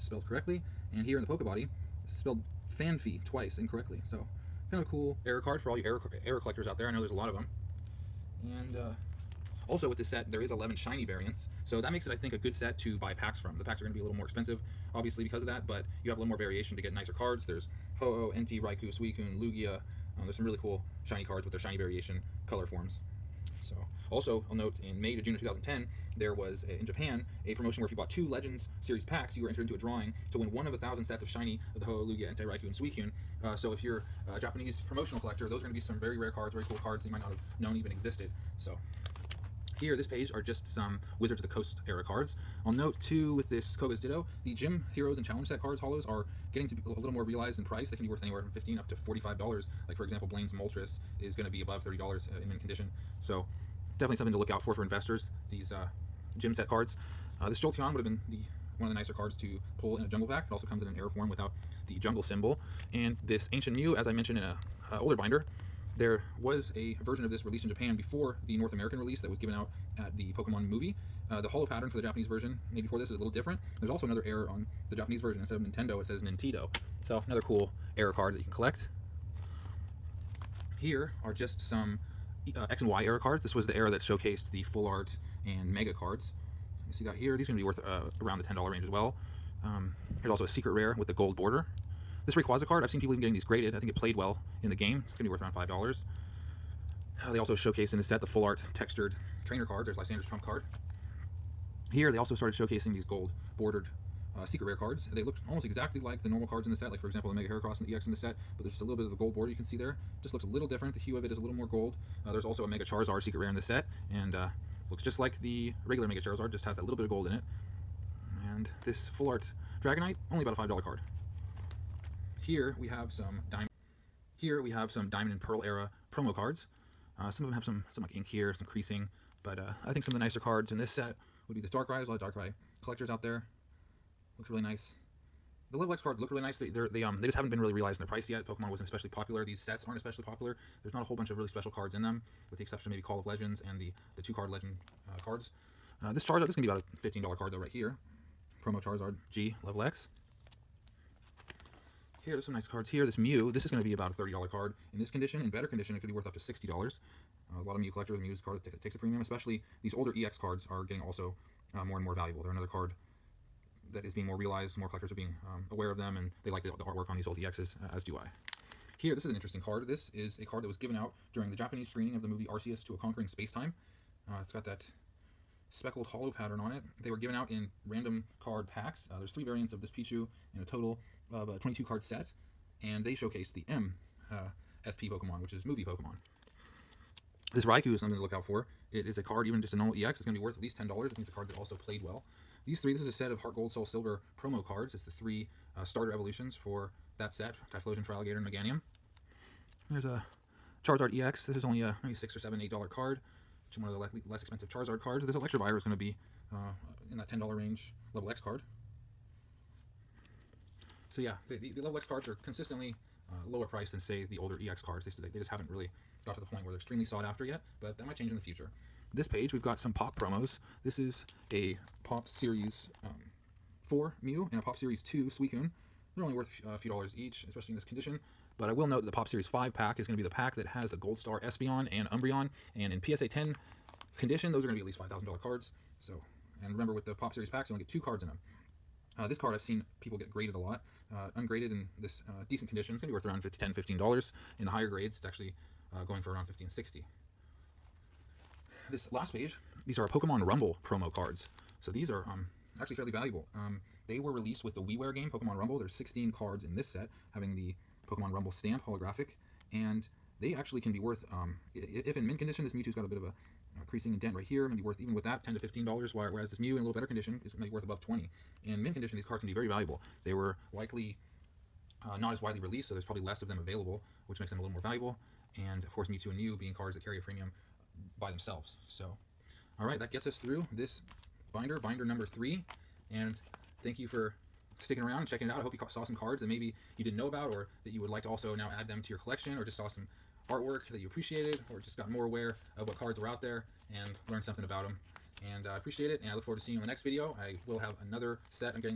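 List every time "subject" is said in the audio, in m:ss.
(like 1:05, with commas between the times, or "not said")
not said.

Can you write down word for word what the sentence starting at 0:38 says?
So here, this page are just some Wizards of the Coast era cards.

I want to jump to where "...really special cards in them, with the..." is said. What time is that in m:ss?
2:21.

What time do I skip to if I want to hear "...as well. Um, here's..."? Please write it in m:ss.
1:28.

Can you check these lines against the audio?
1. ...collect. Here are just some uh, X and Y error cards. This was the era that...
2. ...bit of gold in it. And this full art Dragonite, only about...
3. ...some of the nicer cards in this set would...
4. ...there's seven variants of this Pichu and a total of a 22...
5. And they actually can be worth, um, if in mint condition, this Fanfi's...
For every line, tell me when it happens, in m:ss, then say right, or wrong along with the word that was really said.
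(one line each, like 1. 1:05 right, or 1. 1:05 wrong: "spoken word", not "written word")
1. 1:18 right
2. 1:56 right
3. 2:10 right
4. 2:59 wrong: "three", not "seven"
5. 4:19 wrong: "Mewtwo", not "Fanfi".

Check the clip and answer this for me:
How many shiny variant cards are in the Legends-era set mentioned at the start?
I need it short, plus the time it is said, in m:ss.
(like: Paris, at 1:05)
11, at 0:10.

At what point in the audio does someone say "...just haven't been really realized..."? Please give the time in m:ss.
2:17.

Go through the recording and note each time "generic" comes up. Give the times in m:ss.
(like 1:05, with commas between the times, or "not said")
not said.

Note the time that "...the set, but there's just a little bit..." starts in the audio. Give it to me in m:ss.
1:48.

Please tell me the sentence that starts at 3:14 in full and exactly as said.
It's the three uh, starter evolutions for that set, Typhlosion Feraligatr and Meganium.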